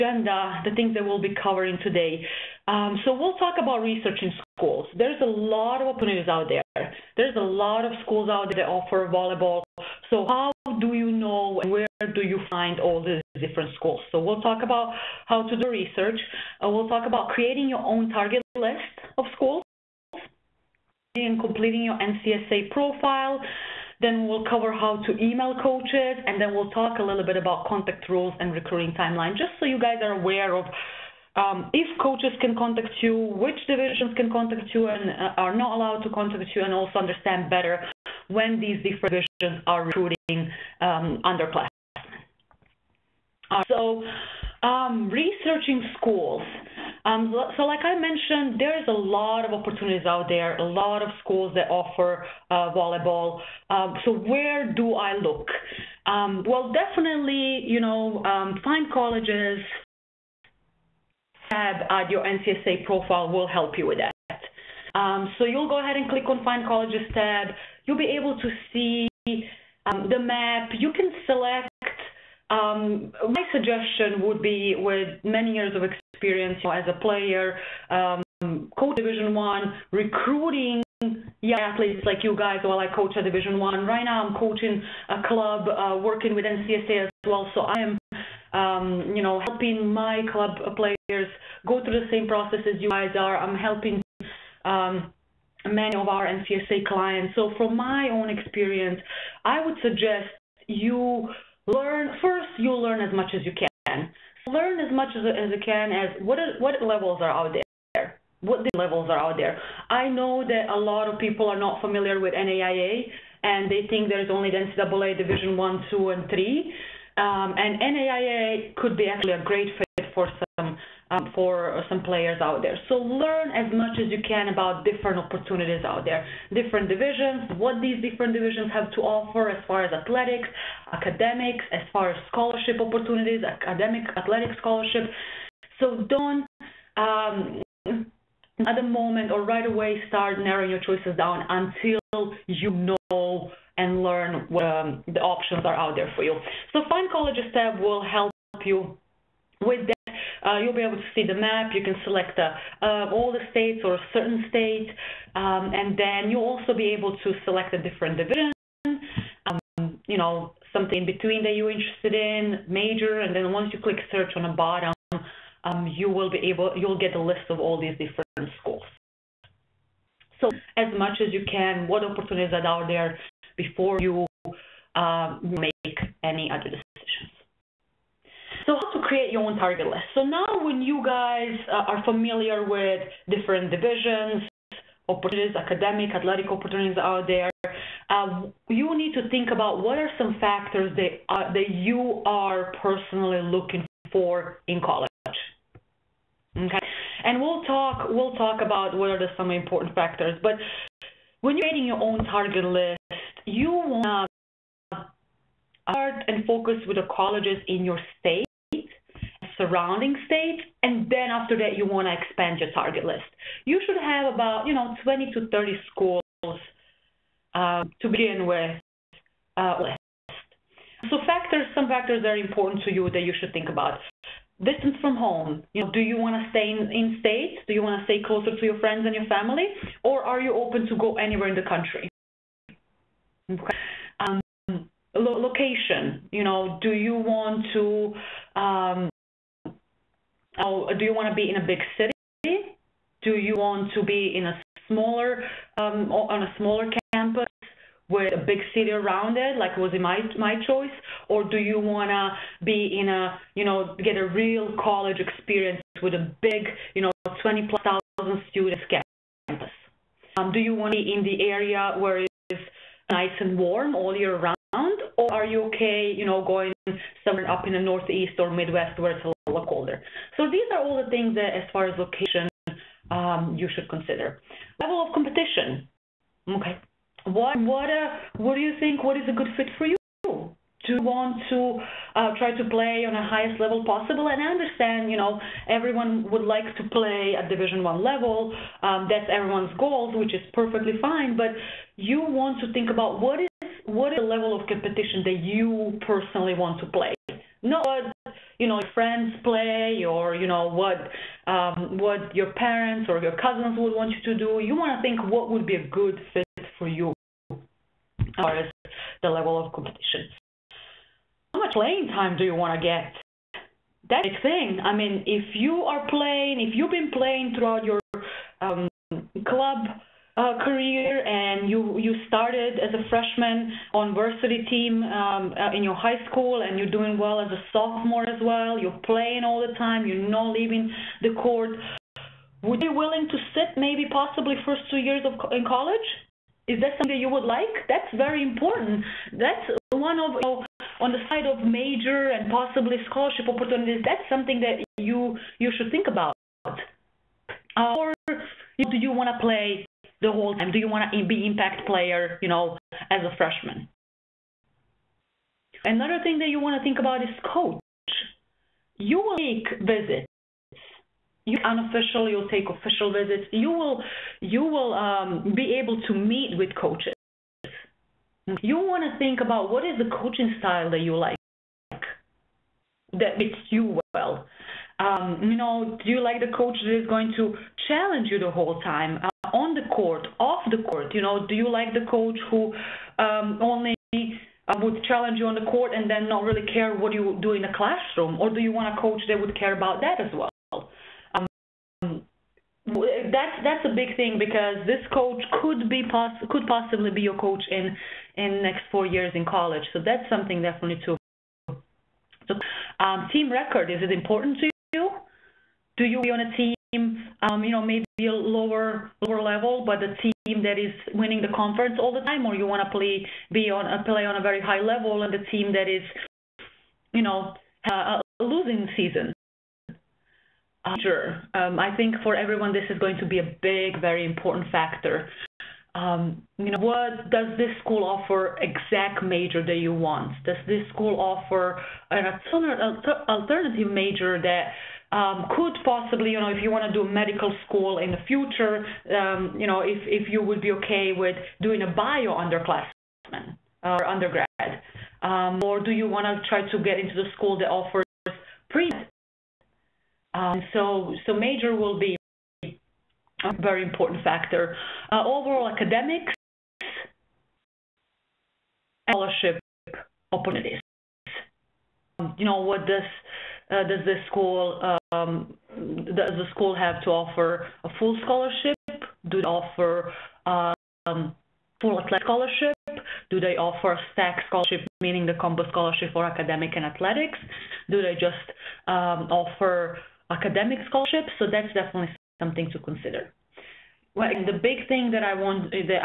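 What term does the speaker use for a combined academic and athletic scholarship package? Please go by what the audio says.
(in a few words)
stack scholarship.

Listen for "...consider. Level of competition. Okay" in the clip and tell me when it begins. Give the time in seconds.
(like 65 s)
273 s.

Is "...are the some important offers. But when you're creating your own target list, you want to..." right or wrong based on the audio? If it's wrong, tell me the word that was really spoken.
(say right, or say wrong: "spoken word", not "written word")
wrong: "factors", not "offers".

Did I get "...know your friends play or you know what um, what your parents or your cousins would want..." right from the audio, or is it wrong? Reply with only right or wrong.
right.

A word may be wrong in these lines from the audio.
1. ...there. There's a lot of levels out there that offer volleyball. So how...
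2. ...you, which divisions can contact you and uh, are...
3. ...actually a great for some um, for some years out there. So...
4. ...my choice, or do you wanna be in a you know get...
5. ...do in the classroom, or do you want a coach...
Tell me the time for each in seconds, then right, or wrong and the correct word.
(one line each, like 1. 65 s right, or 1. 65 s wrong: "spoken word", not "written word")
1. 6 s wrong: "schools", not "levels"
2. 33 s right
3. 119 s wrong: "players", not "years"
4. 250 s right
5. 387 s right.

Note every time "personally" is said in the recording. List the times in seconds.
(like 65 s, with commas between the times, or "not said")
192 s, 296 s.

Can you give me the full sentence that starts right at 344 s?
That's something that you you should think about.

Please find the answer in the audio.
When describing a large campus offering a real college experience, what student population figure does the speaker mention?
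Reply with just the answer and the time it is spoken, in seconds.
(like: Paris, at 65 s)
20 plus thousand, at 257 s.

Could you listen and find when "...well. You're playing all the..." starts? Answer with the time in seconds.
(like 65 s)
328 s.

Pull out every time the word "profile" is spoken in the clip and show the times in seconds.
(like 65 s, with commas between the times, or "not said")
22 s, 62 s.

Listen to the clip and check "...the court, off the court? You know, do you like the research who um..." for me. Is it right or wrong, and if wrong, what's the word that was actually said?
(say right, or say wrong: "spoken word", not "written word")
wrong: "coach", not "research".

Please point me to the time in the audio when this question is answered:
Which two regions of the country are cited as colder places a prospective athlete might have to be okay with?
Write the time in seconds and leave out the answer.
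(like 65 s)
267 s.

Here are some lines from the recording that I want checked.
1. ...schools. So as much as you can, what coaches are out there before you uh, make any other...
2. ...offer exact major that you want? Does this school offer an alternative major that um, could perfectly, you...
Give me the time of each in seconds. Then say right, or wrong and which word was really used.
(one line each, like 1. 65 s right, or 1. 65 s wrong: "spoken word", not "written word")
1. 168 s wrong: "opportunities", not "coaches"
2. 428 s wrong: "possibly", not "perfectly".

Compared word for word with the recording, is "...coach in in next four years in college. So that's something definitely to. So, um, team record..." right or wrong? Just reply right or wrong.
right.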